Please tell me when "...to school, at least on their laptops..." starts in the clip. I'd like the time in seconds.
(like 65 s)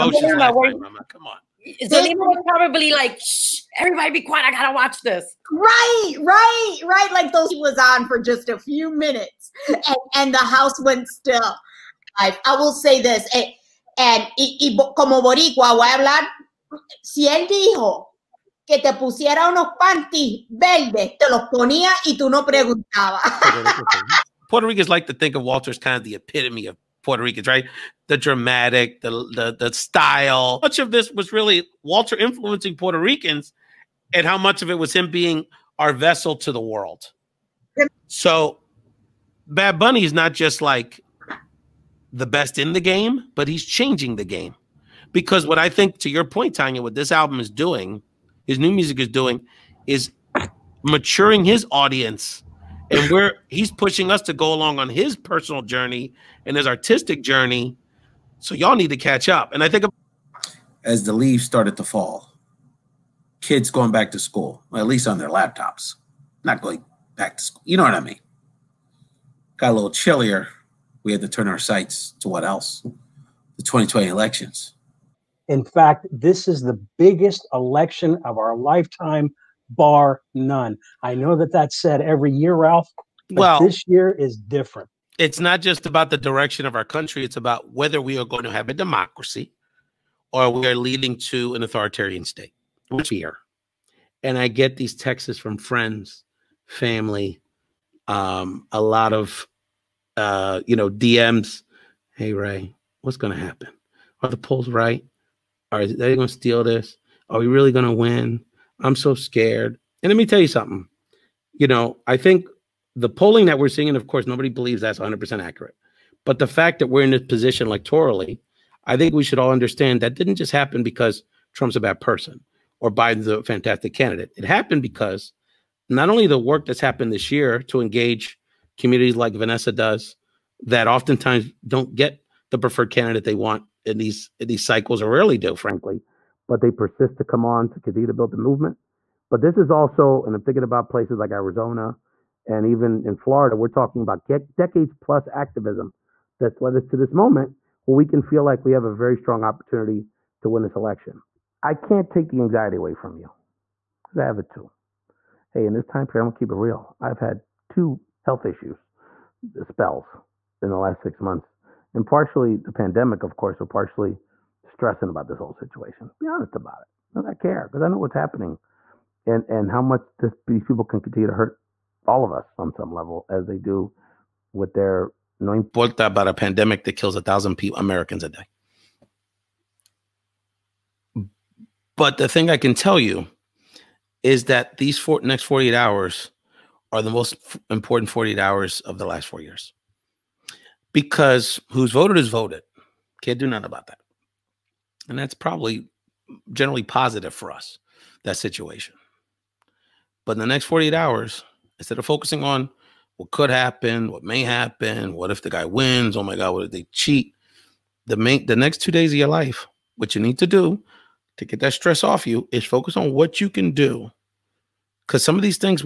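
64 s.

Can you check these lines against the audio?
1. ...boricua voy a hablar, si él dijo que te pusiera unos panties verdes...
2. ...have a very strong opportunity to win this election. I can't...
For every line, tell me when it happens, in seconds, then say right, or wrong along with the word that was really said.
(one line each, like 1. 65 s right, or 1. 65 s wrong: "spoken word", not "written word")
1. 15 s right
2. 148 s right.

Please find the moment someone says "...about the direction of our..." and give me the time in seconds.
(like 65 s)
85 s.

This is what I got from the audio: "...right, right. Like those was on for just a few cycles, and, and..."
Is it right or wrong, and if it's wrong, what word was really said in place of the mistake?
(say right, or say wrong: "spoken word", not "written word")
wrong: "minutes", not "cycles".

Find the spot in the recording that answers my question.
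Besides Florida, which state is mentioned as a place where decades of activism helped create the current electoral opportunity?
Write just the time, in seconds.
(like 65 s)
141 s.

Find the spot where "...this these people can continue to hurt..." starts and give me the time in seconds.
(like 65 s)
170 s.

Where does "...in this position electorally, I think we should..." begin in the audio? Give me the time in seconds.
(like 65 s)
117 s.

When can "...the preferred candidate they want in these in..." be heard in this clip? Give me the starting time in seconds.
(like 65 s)
132 s.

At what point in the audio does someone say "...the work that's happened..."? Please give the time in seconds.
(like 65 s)
126 s.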